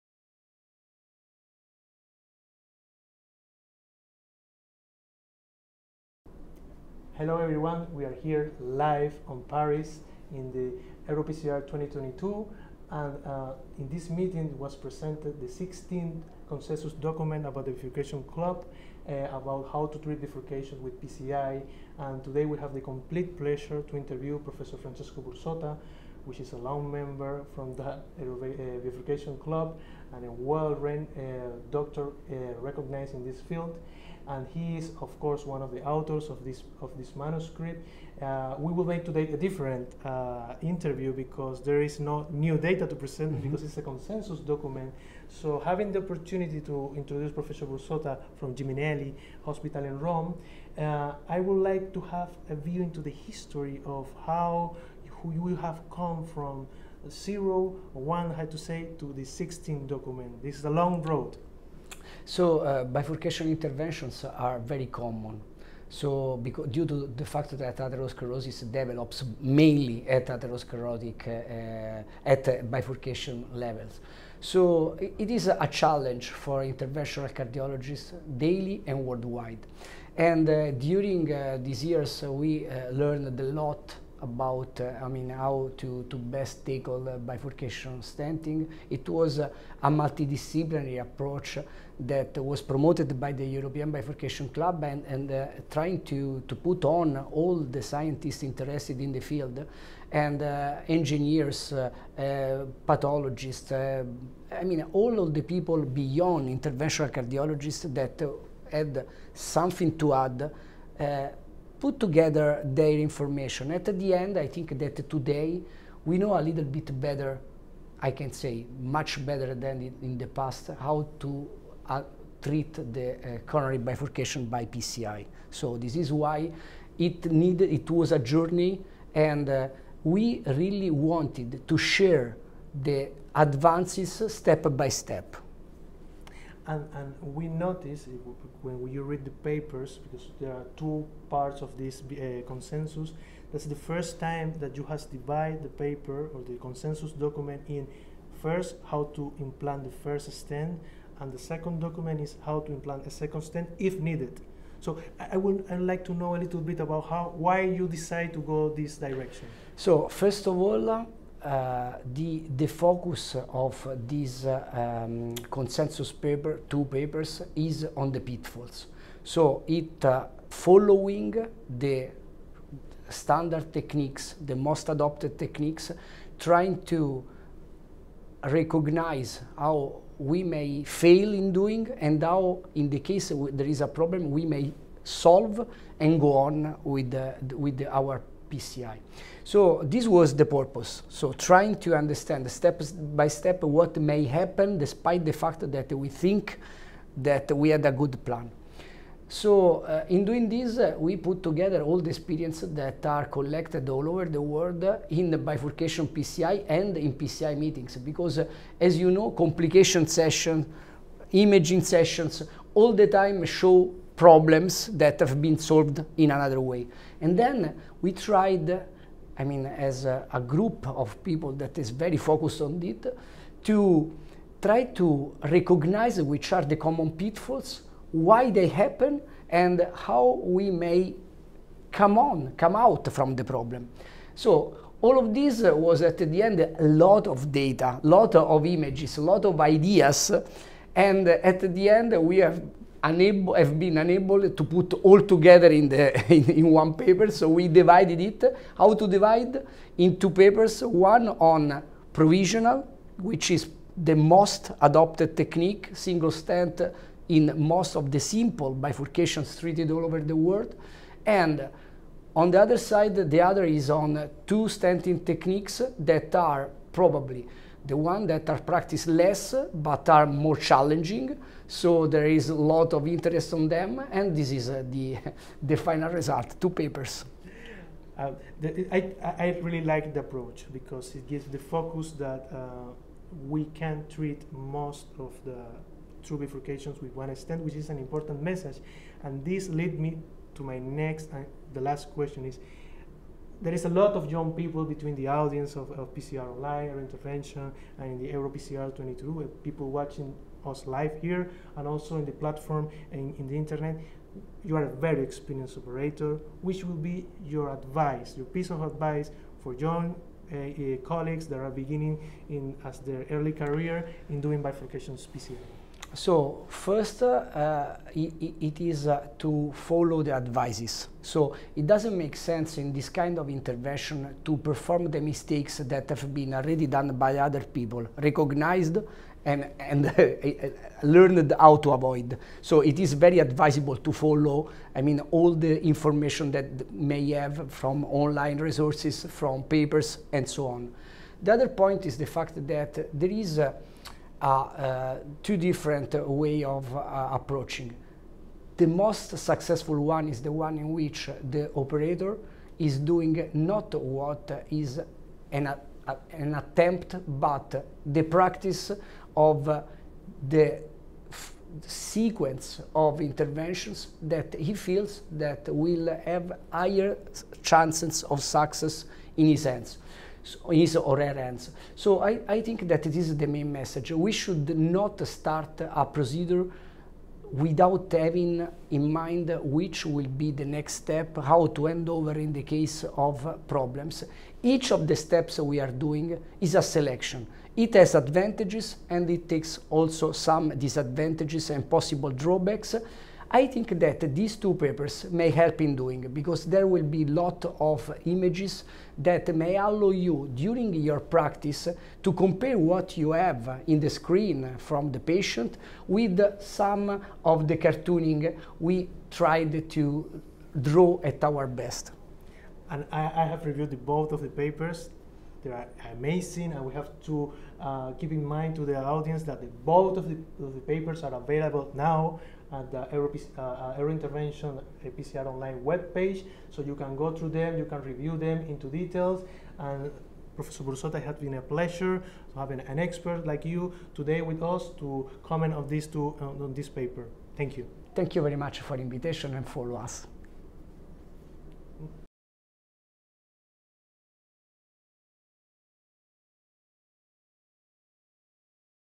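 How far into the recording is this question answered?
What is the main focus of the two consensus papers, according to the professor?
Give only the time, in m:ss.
2:48.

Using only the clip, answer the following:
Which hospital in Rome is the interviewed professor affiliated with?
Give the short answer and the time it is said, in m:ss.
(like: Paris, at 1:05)
Gemelli Hospital, at 0:48.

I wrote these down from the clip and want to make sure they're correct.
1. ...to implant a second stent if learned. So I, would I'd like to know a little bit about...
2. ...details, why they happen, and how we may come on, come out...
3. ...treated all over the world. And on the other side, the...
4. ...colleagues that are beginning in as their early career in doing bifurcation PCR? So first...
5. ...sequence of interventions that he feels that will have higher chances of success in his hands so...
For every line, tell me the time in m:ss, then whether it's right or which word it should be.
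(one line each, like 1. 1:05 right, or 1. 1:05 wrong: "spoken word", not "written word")
1. 2:32 wrong: "needed", not "learned"
2. 3:47 wrong: "pitfalls", not "details"
3. 4:19 right
4. 5:11 right
5. 6:01 right.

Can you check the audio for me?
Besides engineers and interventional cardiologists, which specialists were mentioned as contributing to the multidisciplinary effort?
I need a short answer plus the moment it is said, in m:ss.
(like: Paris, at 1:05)
Pathologists, at 1:42.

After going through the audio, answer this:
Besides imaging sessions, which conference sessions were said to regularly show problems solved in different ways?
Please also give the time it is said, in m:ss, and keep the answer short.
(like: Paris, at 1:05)
Complication sessions, at 3:29.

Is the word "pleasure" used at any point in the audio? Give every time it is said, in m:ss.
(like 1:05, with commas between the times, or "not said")
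0:23, 7:11.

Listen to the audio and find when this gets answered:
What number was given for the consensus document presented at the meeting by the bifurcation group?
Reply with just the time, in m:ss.
0:15.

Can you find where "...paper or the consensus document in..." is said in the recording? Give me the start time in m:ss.
2:25.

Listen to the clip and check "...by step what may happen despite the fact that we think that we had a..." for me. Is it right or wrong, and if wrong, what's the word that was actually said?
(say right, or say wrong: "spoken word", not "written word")
right.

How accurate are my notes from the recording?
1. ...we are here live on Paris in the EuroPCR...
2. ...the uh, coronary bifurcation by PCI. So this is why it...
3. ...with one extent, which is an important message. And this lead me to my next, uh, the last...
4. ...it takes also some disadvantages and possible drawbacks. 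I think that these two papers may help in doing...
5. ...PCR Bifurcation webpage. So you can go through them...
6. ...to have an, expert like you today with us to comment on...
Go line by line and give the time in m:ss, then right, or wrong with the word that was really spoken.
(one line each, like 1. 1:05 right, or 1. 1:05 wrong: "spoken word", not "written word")
1. 0:07 right
2. 2:02 right
3. 4:47 right
4. 6:29 right
5. 7:05 wrong: "Online", not "Bifurcation"
6. 7:12 right.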